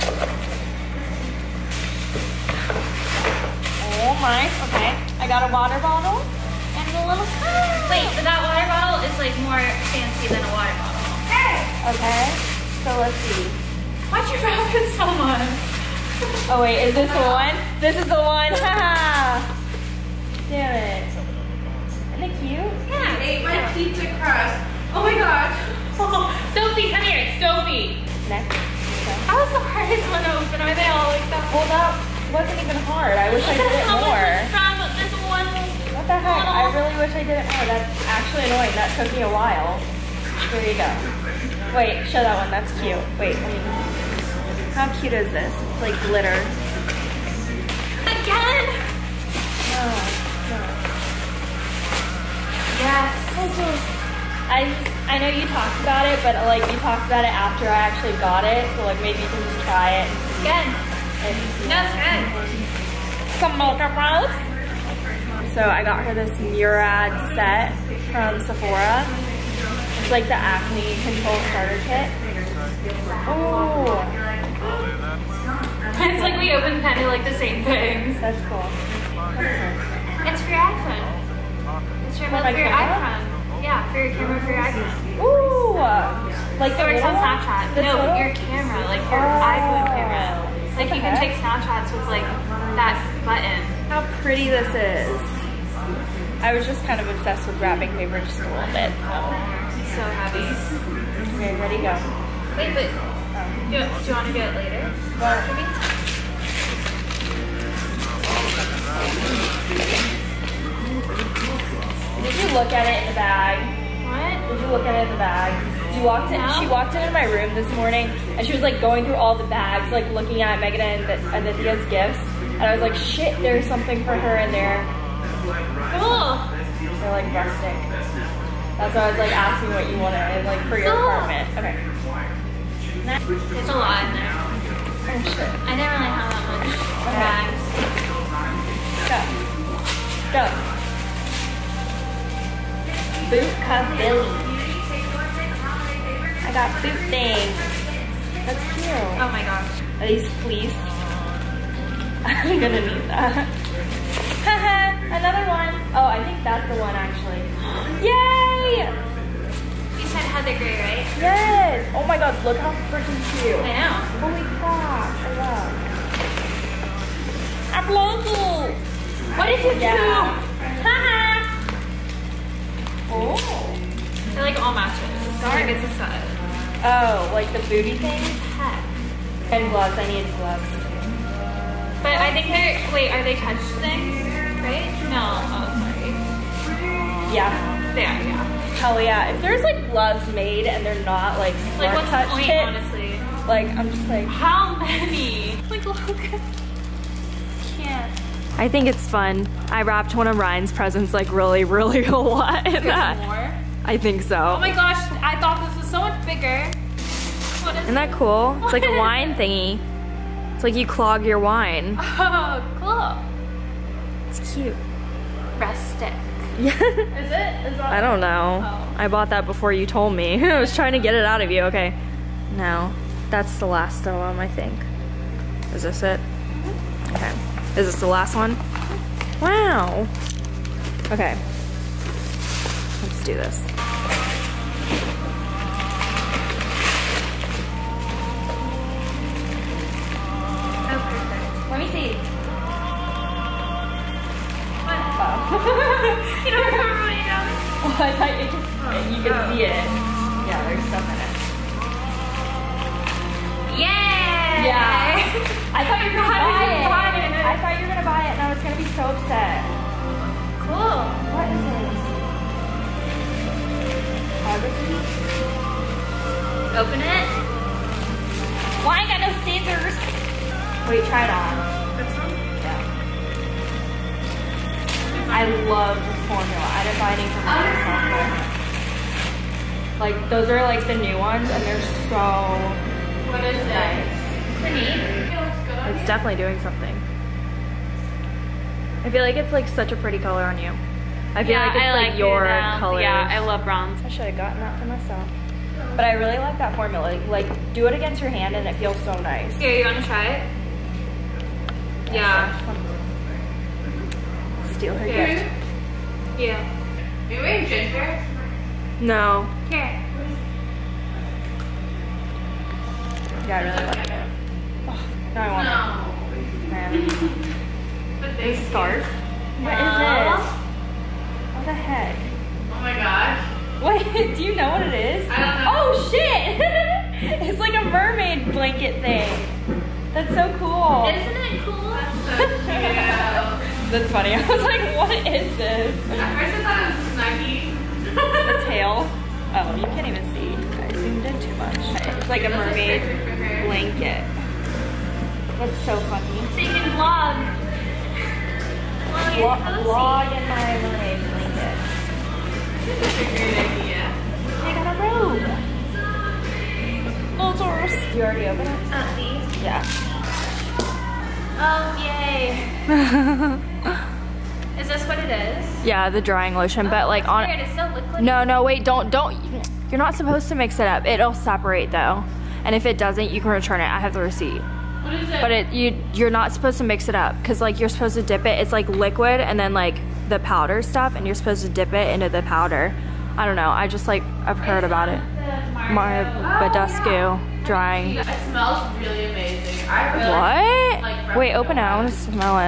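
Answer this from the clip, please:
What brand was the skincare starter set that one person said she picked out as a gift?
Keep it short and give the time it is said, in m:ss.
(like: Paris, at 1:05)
Murad, at 1:06.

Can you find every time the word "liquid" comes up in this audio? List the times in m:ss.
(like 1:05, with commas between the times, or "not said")
6:18.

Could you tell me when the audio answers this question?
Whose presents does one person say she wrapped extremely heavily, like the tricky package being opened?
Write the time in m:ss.
3:20.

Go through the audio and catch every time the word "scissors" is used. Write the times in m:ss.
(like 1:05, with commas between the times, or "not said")
4:29.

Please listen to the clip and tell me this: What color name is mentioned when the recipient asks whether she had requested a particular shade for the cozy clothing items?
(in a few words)
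Heather Gray.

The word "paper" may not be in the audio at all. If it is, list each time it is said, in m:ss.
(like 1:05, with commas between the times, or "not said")
1:37.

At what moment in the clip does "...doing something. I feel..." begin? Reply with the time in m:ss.
4:46.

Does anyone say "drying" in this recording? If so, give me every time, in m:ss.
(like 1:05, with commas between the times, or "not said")
6:06, 6:27.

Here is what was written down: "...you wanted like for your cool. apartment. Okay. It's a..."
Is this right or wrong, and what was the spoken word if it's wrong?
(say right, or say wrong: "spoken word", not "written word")
right.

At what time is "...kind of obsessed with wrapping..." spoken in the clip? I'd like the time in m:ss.
1:36.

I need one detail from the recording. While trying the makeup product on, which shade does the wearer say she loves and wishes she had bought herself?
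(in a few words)
bronze.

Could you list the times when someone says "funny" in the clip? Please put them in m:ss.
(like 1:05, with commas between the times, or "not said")
5:34, 5:46.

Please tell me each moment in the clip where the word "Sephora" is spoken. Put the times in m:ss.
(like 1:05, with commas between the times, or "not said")
1:08.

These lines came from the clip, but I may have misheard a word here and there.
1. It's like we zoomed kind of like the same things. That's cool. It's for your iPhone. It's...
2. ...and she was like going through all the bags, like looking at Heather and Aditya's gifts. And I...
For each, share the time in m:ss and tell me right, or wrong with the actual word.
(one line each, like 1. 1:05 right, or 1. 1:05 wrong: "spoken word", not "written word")
1. 1:15 wrong: "opened", not "zoomed"
2. 1:58 wrong: "Megan", not "Heather".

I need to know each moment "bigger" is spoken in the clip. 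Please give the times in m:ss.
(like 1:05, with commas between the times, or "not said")
3:26.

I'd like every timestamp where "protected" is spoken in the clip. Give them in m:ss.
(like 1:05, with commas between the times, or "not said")
not said.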